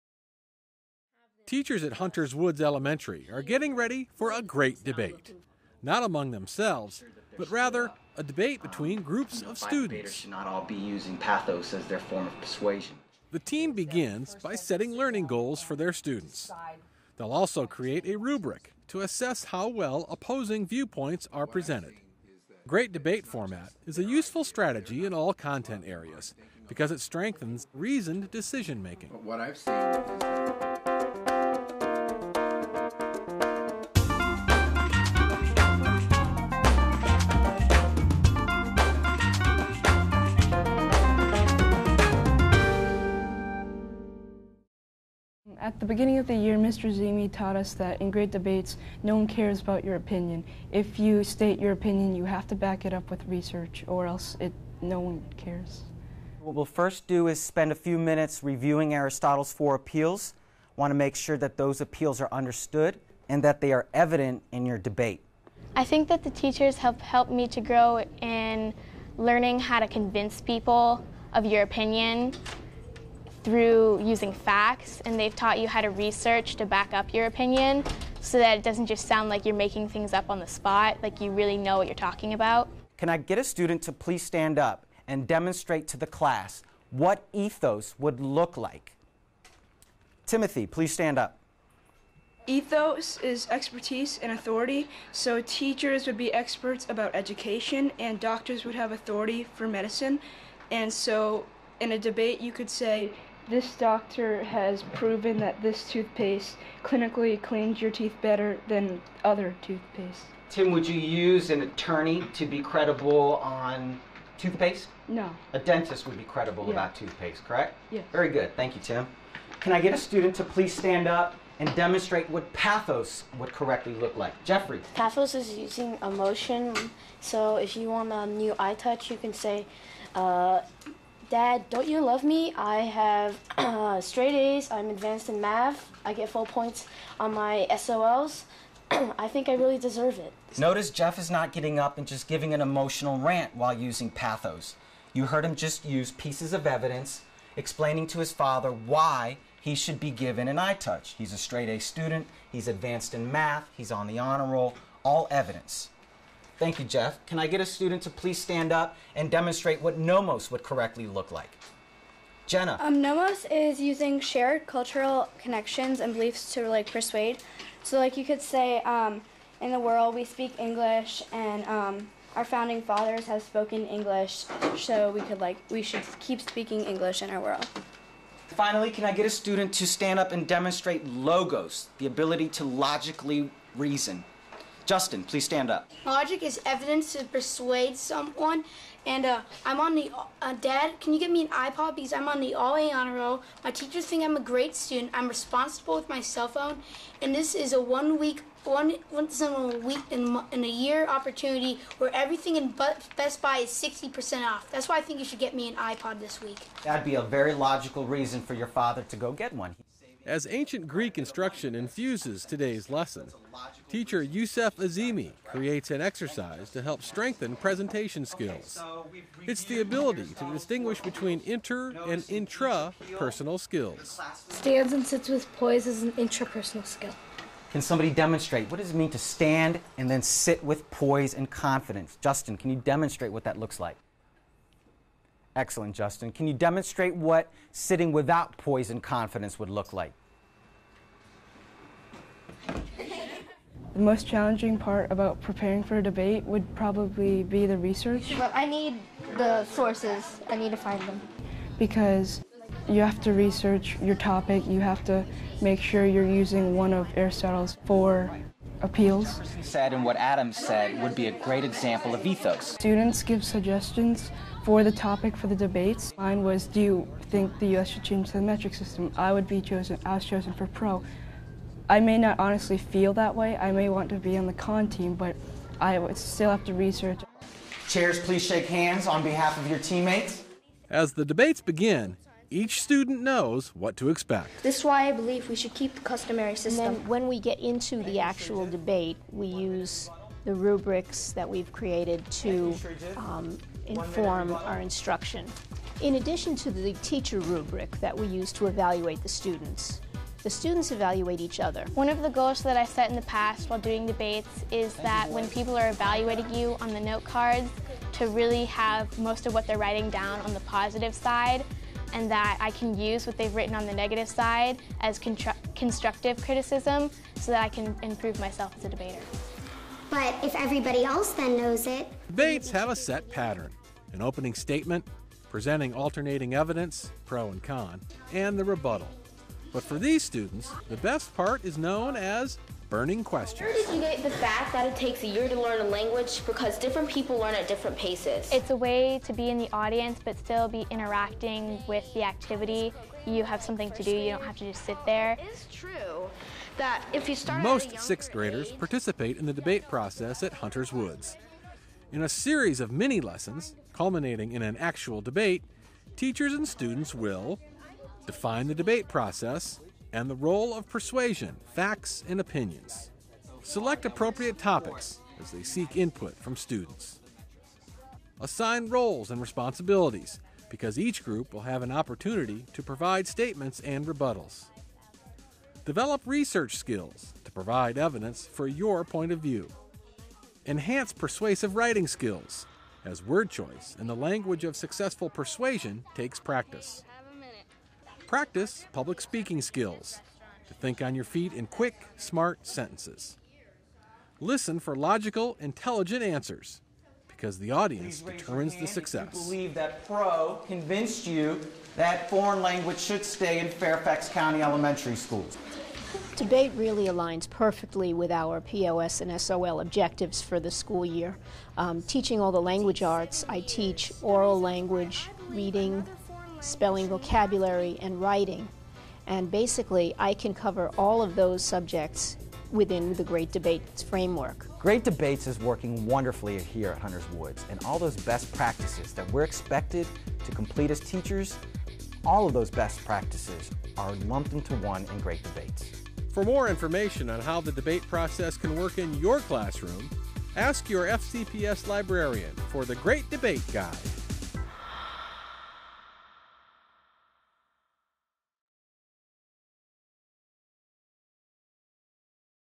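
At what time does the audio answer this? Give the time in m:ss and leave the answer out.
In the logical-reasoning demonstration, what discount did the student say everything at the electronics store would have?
3:23.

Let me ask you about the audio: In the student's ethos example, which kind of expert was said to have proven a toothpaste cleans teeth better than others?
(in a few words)
Doctor.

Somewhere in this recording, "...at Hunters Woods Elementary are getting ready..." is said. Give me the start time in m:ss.
0:01.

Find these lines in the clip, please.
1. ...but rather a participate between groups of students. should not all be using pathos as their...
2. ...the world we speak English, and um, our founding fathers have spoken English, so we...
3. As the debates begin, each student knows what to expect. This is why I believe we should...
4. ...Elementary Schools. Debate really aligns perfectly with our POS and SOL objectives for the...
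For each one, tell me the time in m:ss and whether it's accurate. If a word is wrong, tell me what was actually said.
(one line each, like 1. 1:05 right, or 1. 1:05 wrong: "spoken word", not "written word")
1. 0:07 wrong: "debate", not "participate"
2. 2:49 right
3. 4:40 right
4. 6:44 right.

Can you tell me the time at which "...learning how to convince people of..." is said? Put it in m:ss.
1:09.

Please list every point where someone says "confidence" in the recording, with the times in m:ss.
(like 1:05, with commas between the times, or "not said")
3:51, 3:59.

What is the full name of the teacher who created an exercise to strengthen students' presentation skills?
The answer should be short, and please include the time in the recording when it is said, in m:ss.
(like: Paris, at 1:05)
Youssef Azimi, at 3:34.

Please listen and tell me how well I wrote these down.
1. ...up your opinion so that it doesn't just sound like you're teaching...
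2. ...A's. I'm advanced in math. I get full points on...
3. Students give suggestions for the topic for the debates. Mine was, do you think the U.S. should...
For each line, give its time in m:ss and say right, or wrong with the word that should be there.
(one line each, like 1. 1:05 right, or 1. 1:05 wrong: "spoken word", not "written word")
1. 1:16 wrong: "making", not "teaching"
2. 2:14 right
3. 4:22 right.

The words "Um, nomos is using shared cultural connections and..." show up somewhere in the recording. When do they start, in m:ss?
2:42.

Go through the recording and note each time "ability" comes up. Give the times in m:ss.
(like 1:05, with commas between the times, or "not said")
3:02, 3:39.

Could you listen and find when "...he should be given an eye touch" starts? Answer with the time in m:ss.
2:29.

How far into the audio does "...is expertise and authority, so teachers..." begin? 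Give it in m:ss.
1:33.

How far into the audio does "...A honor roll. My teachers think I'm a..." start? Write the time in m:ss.
3:12.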